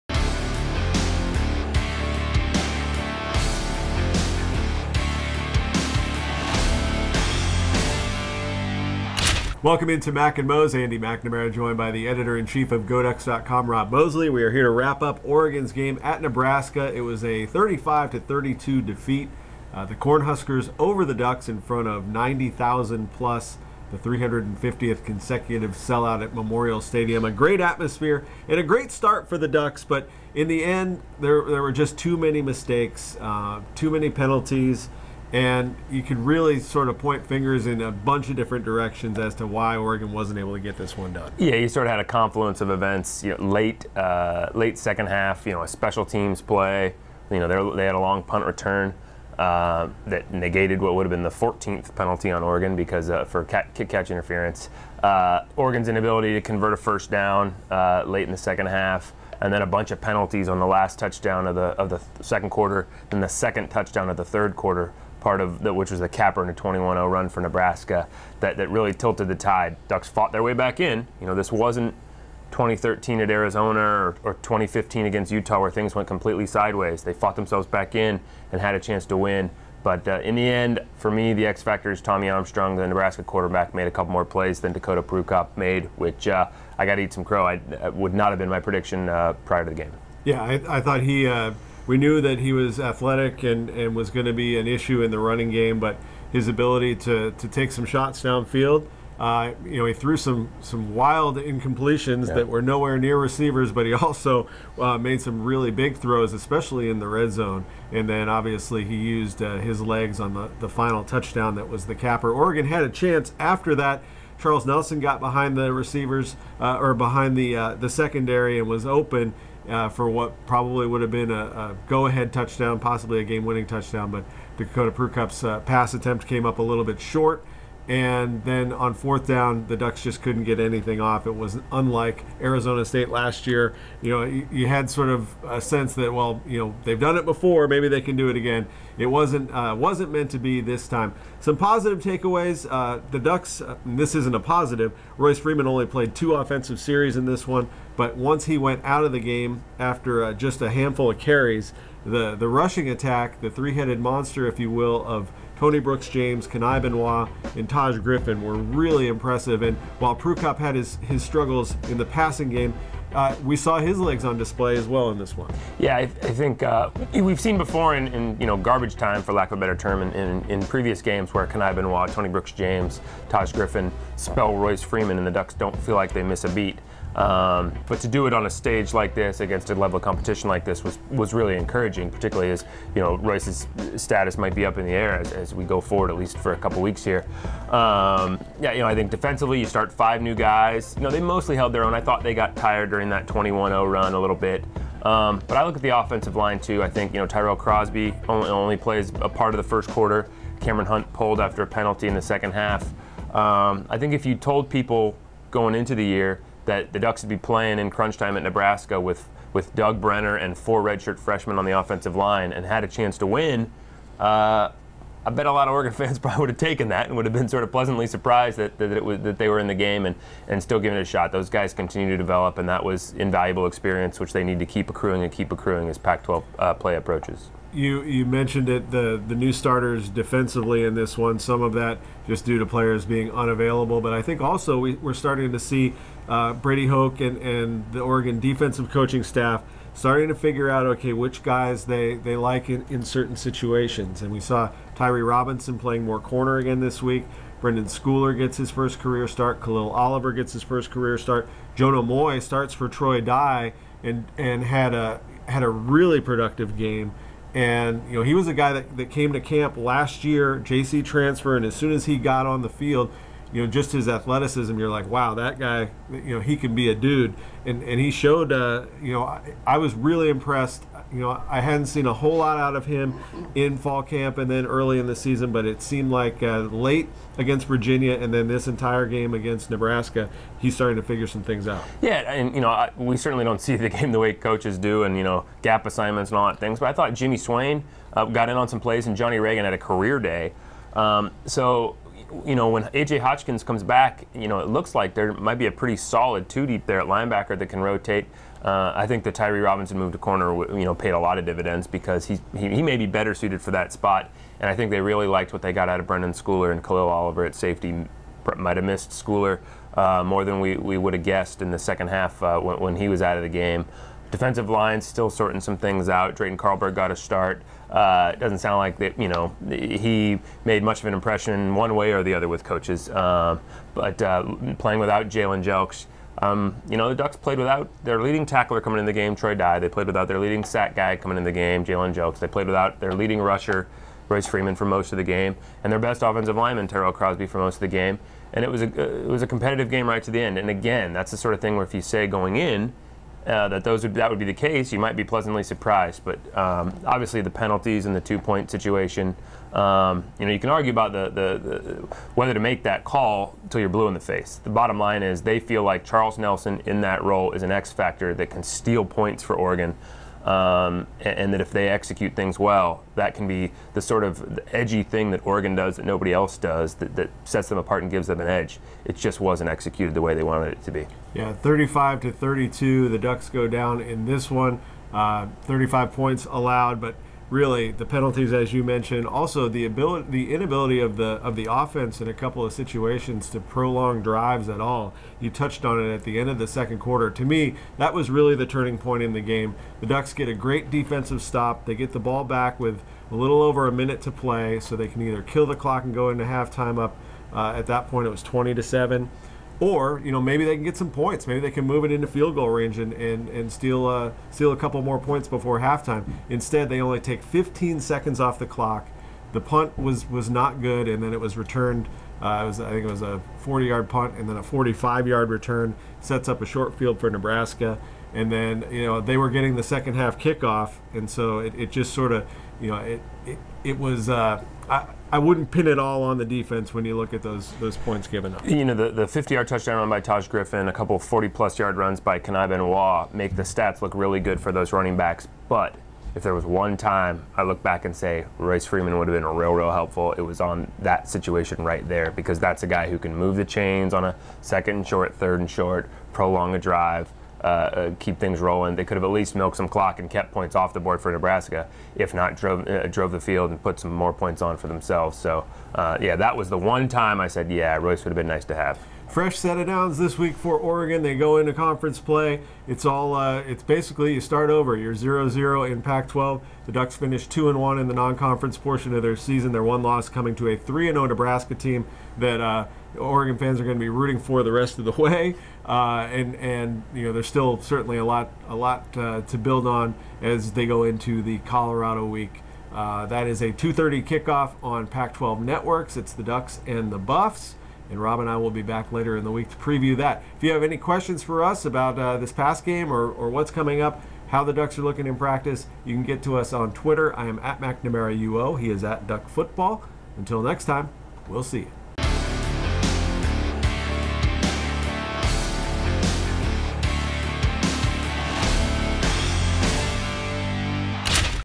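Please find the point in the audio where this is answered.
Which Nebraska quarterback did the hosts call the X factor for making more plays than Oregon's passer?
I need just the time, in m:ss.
1:22.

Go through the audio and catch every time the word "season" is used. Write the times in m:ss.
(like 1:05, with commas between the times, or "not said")
4:35, 7:49.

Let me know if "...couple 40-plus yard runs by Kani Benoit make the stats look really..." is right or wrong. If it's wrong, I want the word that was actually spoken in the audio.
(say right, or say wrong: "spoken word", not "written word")
right.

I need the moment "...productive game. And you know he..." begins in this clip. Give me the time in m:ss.
4:16.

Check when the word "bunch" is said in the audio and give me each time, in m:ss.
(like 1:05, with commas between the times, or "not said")
0:37, 0:59.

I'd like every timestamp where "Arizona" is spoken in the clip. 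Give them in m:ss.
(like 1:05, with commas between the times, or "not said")
1:13, 2:12.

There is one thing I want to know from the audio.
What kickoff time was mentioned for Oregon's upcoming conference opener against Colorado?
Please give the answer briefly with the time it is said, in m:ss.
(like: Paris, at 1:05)
2:30, at 8:03.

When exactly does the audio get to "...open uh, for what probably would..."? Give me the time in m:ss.
1:58.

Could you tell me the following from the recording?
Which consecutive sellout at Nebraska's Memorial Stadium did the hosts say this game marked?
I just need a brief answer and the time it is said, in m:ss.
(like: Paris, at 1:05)
350th, at 0:23.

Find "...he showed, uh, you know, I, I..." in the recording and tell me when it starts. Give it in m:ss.
4:27.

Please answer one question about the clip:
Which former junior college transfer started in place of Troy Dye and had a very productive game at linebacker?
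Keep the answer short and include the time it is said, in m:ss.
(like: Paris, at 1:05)
Jonah Moi, at 4:11.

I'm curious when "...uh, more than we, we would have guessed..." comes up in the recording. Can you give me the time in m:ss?
5:09.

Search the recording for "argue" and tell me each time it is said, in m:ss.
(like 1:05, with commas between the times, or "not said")
5:50.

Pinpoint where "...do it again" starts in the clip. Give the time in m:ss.
2:18.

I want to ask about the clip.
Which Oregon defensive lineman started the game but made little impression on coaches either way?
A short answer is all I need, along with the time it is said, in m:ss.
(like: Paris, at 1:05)
Drayton Carlberg, at 5:16.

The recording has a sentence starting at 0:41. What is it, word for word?
Yeah, you sort of had a confluence of events.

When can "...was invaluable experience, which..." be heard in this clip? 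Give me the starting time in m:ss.
3:42.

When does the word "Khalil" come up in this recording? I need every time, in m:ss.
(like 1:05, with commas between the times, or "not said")
4:09, 5:06.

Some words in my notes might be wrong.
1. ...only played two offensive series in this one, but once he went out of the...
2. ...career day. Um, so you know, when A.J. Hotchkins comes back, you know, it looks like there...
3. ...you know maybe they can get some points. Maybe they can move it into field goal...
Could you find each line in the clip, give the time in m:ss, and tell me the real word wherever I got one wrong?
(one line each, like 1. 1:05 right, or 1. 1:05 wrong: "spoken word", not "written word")
1. 2:25 right
2. 4:49 right
3. 6:40 right.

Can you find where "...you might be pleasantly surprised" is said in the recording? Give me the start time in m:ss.
5:44.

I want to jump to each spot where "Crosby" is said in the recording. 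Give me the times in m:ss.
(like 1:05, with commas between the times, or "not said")
3:17, 5:37.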